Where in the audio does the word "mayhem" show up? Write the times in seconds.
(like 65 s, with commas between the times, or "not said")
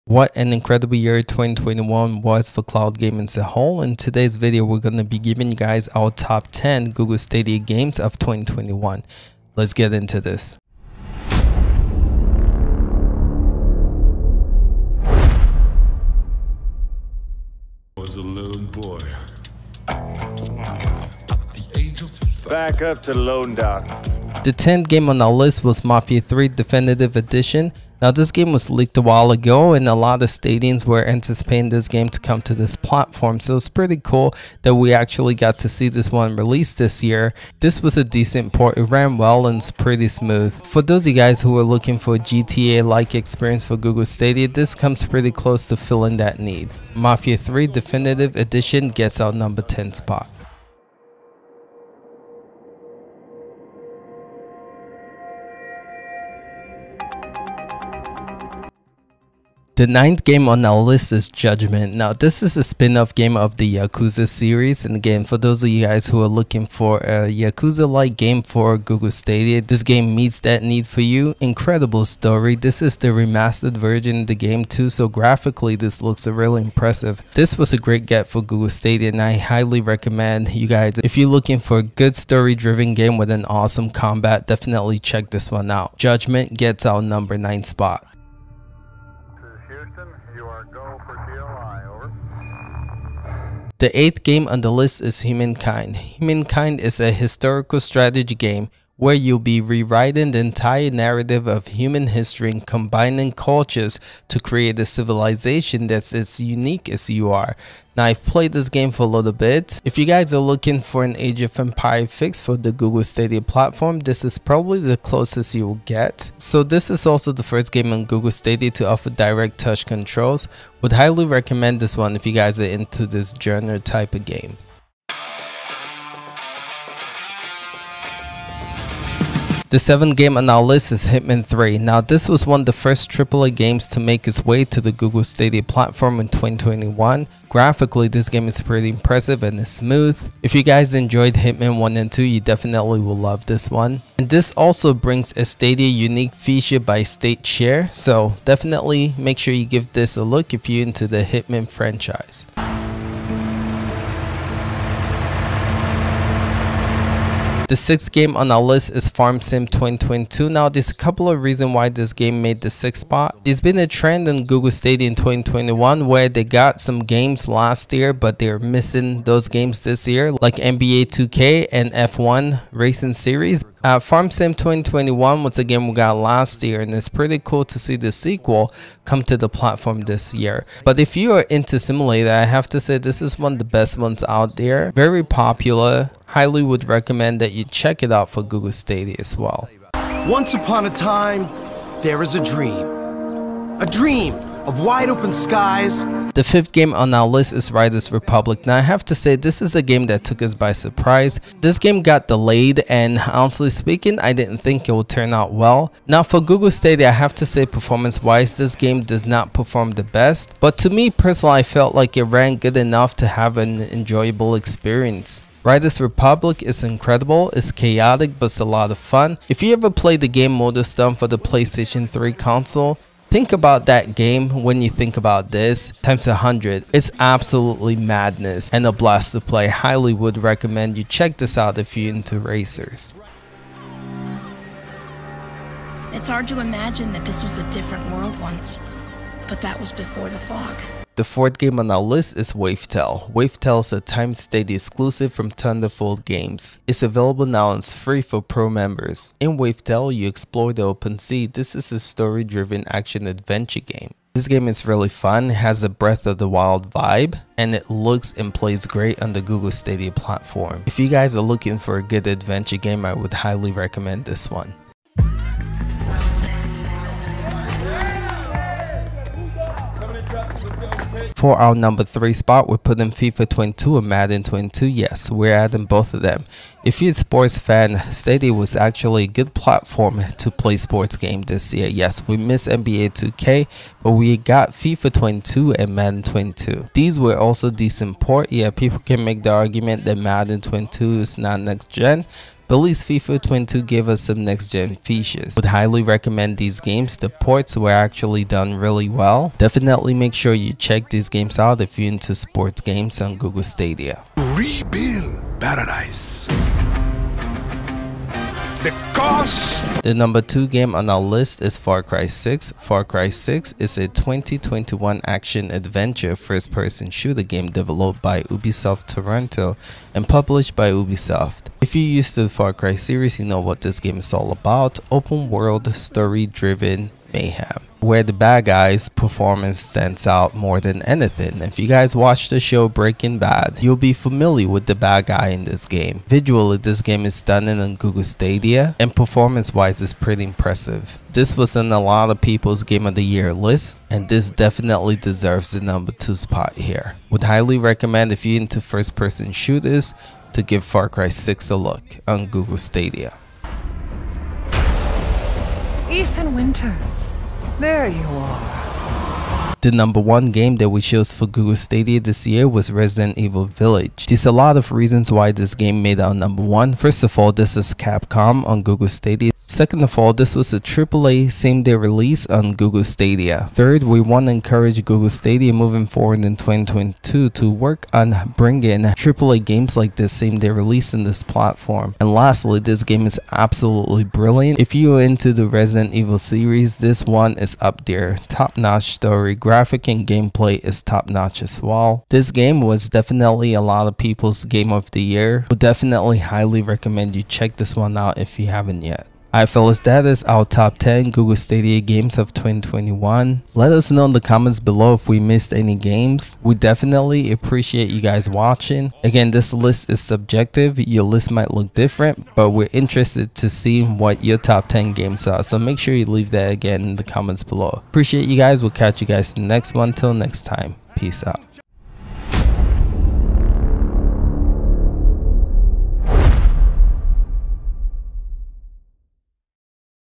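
327 s.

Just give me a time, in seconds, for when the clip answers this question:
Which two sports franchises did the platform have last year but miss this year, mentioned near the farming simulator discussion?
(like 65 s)
170 s.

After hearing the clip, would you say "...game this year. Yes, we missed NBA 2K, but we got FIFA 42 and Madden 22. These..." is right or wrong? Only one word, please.
wrong.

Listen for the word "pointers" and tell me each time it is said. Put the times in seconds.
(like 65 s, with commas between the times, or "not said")
not said.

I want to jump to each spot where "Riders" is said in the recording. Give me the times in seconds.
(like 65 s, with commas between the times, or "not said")
197 s, 215 s.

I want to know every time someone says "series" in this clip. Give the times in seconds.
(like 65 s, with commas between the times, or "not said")
64 s, 173 s, 322 s, 386 s.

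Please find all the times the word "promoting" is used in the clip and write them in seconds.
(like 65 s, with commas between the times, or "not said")
not said.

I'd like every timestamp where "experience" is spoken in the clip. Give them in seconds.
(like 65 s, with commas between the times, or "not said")
43 s, 214 s.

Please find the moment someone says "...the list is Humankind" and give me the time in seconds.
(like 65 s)
94 s.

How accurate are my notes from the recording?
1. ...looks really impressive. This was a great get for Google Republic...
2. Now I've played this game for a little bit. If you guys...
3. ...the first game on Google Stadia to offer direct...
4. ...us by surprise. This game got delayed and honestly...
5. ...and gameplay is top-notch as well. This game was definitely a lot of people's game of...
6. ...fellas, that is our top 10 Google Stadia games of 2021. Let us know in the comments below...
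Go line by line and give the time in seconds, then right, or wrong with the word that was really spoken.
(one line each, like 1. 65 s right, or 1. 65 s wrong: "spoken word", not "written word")
1. 76 s wrong: "Stadia", not "Republic"
2. 107 s right
3. 117 s right
4. 200 s right
5. 390 s right
6. 399 s right.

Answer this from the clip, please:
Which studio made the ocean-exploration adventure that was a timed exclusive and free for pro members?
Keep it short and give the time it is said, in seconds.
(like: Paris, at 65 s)
Thunderful Games, at 245 s.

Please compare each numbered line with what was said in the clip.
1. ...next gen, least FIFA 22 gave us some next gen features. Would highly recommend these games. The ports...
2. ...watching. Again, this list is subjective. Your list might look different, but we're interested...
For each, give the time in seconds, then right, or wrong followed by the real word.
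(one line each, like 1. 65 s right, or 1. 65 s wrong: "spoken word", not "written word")
1. 291 s right
2. 408 s right.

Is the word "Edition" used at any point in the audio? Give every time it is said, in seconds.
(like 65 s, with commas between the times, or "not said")
27 s, 48 s.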